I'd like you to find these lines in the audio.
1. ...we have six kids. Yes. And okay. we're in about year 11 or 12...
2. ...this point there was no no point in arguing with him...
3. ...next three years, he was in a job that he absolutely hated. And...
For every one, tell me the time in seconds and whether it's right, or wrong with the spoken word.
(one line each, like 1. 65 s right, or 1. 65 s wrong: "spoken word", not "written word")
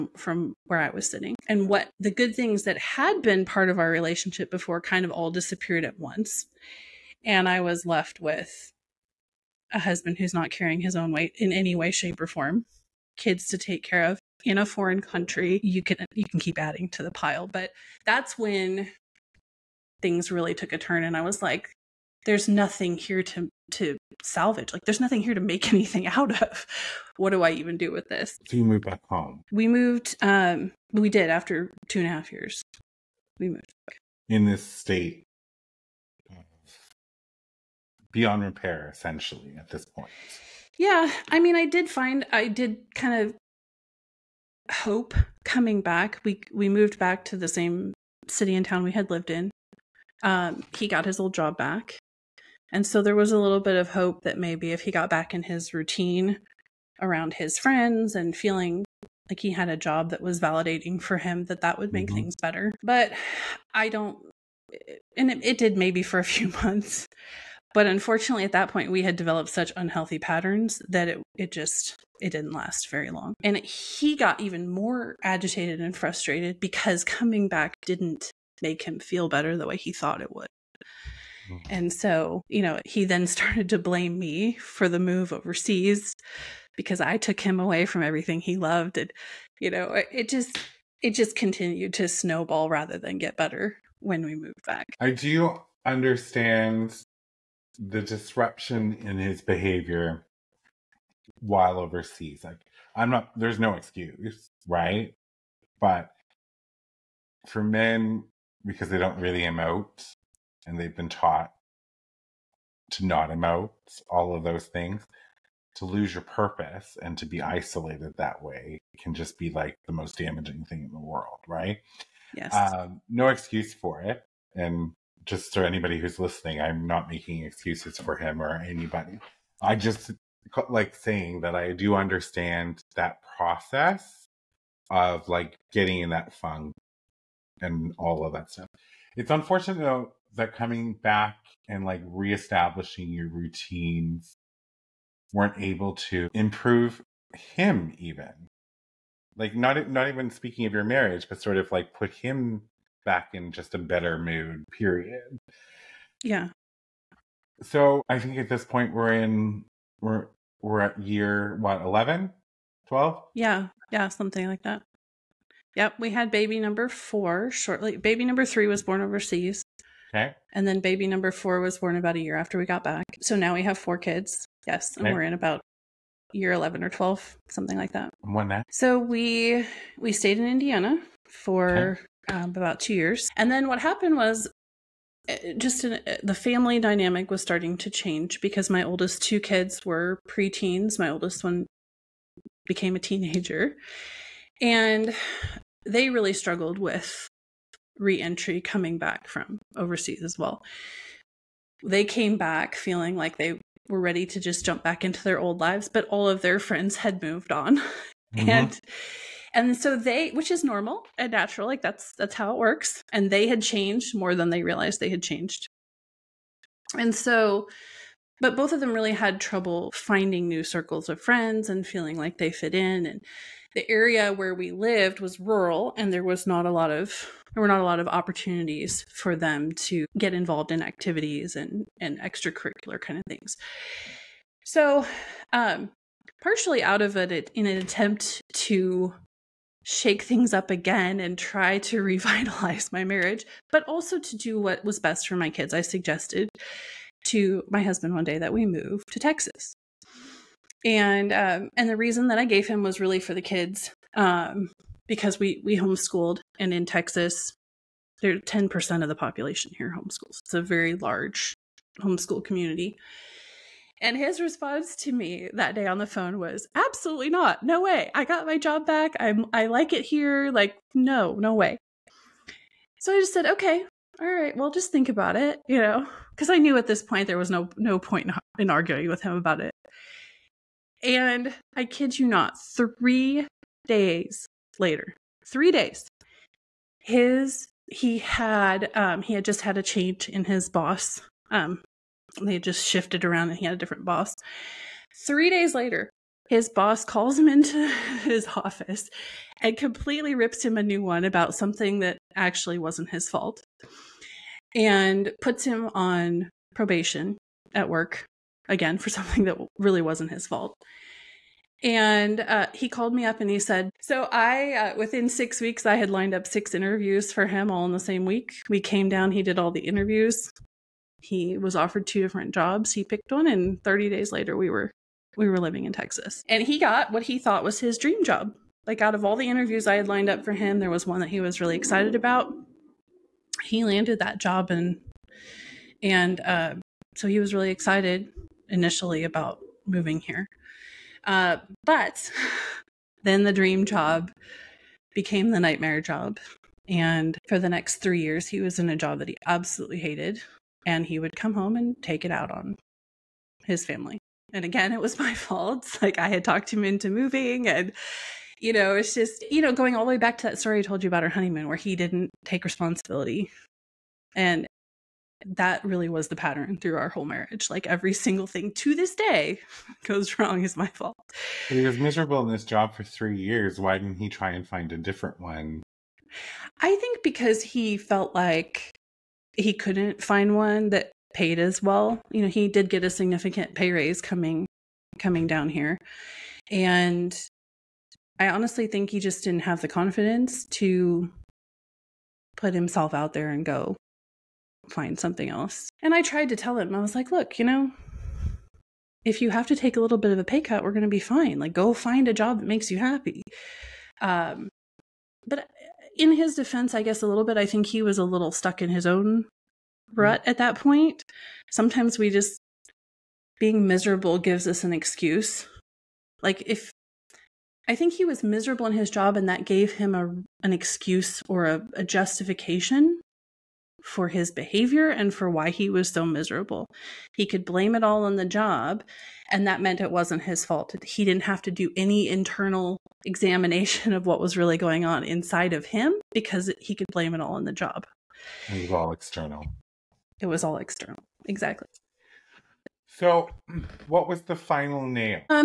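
1. 173 s wrong: "four", not "six"
2. 276 s right
3. 347 s right.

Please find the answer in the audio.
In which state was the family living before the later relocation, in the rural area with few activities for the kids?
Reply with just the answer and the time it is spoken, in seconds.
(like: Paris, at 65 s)
Indiana, at 180 s.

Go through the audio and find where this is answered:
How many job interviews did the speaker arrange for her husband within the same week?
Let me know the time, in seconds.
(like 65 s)
316 s.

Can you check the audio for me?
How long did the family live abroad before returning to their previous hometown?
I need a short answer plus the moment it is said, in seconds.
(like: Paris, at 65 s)
2.5 years, at 31 s.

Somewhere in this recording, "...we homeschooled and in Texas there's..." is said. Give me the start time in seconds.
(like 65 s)
255 s.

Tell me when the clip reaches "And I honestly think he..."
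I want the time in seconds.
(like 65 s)
386 s.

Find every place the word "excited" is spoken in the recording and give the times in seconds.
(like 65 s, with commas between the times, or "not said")
331 s, 337 s.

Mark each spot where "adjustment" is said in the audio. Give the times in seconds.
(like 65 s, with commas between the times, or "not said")
not said.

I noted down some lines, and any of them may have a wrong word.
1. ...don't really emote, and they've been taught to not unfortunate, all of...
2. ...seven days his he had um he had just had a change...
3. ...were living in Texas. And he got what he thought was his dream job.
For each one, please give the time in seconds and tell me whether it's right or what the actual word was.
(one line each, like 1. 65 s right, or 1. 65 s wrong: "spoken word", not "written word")
1. 108 s wrong: "emote", not "unfortunate"
2. 285 s wrong: "three", not "seven"
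3. 325 s right.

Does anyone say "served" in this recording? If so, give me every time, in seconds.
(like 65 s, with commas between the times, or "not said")
not said.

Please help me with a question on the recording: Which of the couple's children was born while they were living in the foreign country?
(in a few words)
Baby number 3.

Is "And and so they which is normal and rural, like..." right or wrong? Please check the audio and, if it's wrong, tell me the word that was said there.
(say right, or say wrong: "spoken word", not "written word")
wrong: "natural", not "rural".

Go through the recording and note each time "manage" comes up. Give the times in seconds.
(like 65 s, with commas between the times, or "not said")
not said.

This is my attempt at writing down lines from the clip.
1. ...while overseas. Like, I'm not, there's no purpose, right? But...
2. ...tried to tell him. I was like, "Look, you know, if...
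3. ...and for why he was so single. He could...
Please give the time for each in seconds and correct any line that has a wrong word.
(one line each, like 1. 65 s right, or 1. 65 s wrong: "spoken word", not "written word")
1. 101 s wrong: "excuse", not "purpose"
2. 396 s right
3. 425 s wrong: "miserable", not "single".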